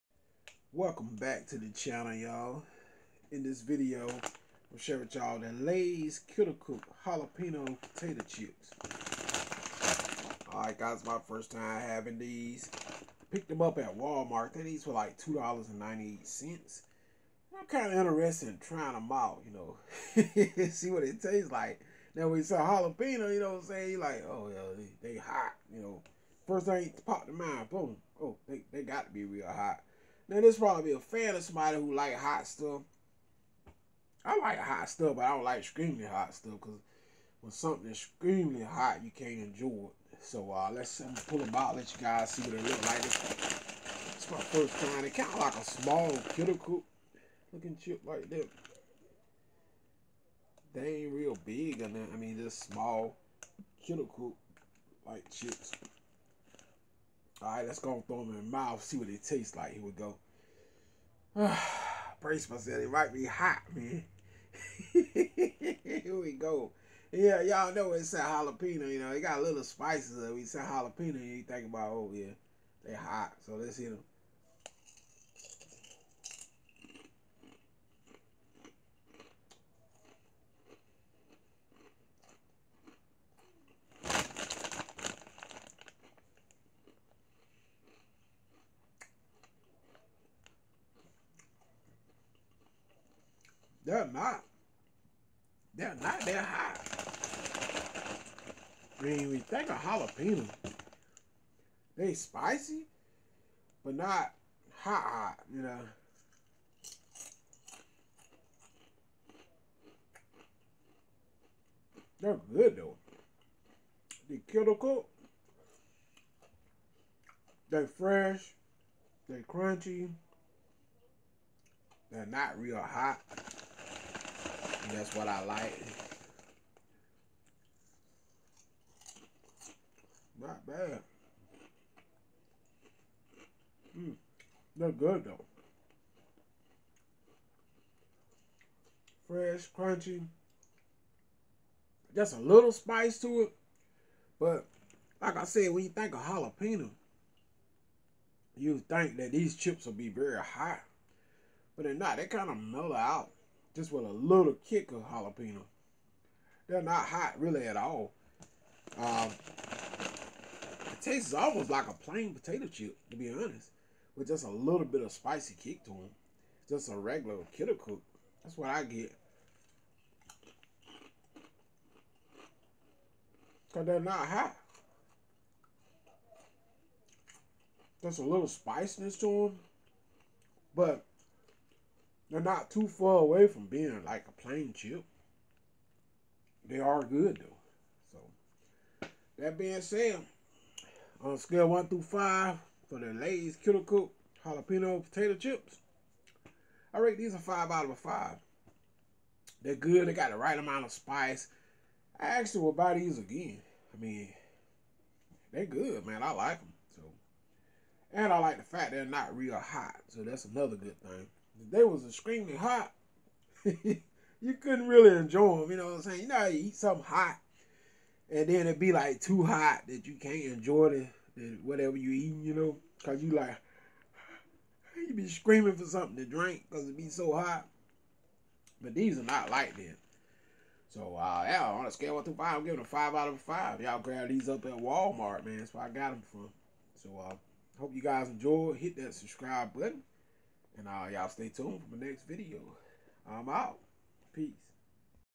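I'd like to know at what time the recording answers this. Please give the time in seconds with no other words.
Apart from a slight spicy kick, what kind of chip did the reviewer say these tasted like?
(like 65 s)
161 s.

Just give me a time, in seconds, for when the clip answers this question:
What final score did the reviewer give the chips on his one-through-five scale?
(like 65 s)
197 s.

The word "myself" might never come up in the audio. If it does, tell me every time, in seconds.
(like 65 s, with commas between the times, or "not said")
62 s.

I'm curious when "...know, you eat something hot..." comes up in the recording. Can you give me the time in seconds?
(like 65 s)
216 s.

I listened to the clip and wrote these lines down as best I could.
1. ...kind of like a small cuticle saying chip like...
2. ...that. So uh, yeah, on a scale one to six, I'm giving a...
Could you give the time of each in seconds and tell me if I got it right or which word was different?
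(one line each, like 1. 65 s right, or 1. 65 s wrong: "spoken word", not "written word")
1. 45 s wrong: "looking", not "saying"
2. 229 s wrong: "five", not "six".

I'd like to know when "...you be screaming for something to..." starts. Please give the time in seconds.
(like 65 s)
224 s.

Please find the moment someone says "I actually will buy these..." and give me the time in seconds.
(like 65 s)
202 s.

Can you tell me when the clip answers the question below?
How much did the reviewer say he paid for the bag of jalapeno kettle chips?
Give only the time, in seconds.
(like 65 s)
15 s.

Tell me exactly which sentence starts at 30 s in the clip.
Then this probably a fan of somebody who like hot stuff.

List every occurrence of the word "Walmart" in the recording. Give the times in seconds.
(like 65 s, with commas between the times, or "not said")
13 s, 234 s.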